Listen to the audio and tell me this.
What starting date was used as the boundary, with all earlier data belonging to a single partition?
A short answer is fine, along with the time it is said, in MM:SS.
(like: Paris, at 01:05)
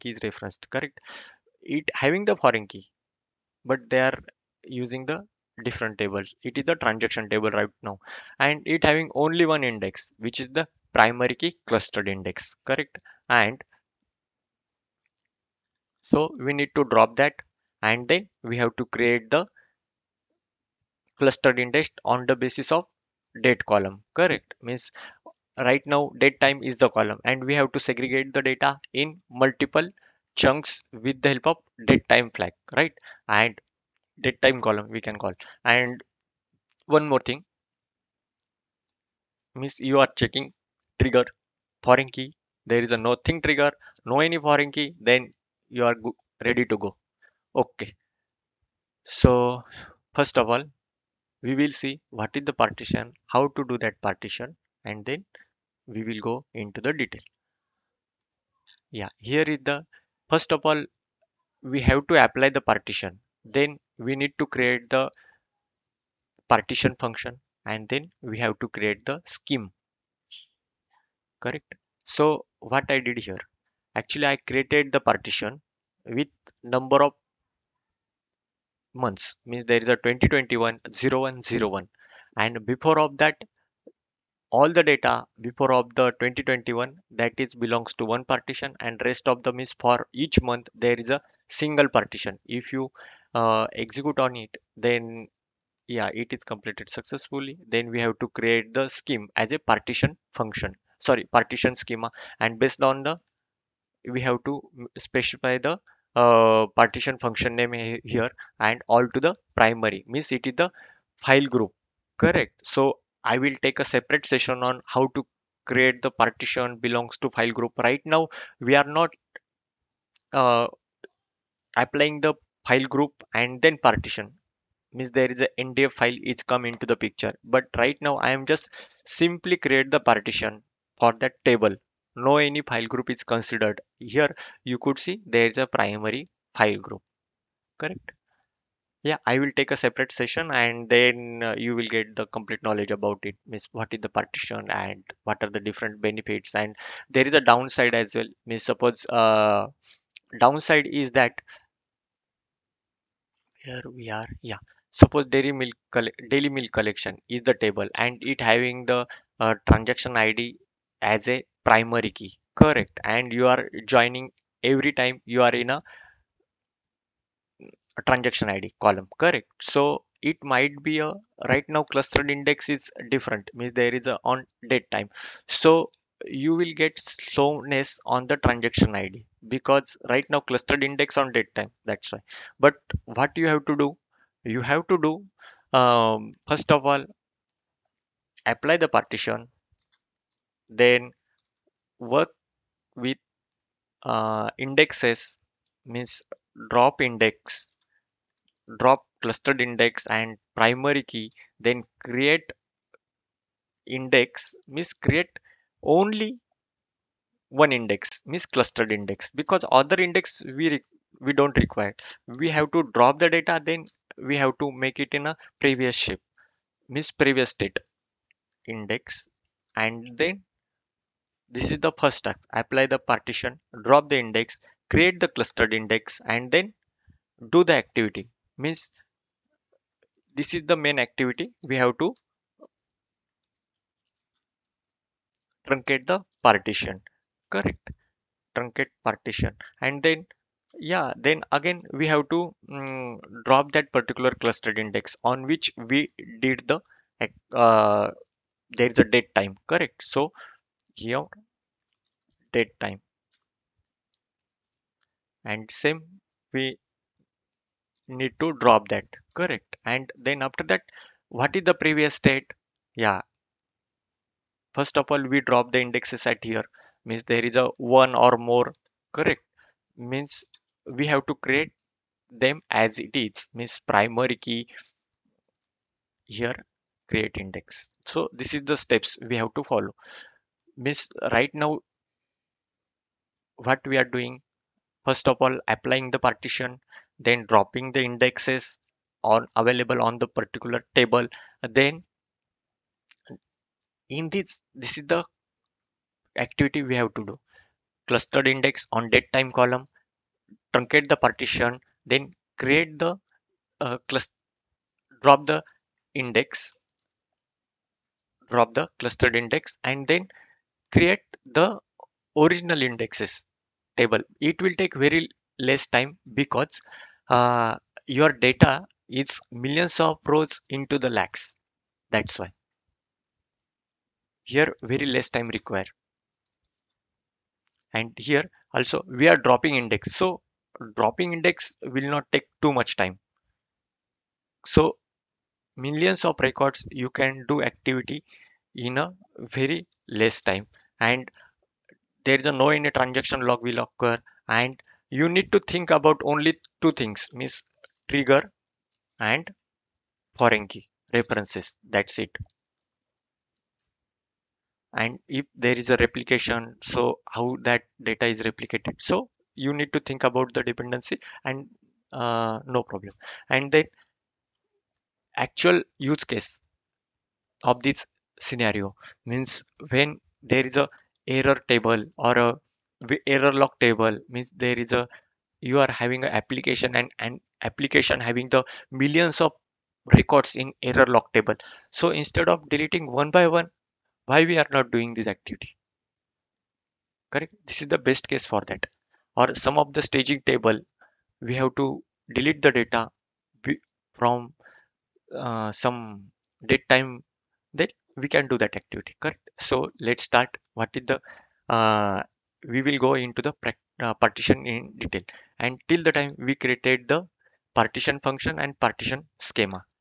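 2021-01-01, at 01:20.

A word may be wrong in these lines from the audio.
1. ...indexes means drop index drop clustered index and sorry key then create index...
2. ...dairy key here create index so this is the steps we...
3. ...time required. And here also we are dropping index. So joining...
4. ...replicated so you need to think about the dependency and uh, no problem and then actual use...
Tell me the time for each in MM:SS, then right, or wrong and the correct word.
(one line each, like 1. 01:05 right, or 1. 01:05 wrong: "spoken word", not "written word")
1. 03:14 wrong: "primary", not "sorry"
2. 04:33 wrong: "primary", not "dairy"
3. 05:25 wrong: "dropping", not "joining"
4. 05:58 right.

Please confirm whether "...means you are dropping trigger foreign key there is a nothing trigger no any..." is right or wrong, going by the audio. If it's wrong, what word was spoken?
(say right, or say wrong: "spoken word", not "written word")
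wrong: "checking", not "dropping".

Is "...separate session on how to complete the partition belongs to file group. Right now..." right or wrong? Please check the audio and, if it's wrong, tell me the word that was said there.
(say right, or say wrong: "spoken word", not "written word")
wrong: "create", not "complete".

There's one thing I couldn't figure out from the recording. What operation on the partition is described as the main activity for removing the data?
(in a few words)
Truncate partition.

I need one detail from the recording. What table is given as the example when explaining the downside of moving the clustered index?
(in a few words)
Daily milk collection.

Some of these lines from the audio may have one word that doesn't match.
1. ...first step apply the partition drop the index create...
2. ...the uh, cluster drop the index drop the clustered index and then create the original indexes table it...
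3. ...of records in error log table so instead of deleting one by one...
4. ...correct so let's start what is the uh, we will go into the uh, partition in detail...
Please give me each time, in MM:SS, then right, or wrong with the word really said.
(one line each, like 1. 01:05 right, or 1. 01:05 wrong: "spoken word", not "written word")
1. 03:41 right
2. 05:03 right
3. 06:19 right
4. 06:39 right.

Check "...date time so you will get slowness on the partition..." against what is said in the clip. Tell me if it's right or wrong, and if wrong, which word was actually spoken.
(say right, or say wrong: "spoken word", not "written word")
wrong: "transaction", not "partition".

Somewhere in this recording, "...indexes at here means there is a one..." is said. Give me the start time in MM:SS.
04:25.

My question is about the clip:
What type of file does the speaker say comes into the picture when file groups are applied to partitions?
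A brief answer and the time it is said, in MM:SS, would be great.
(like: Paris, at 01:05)
ndf file, at 02:05.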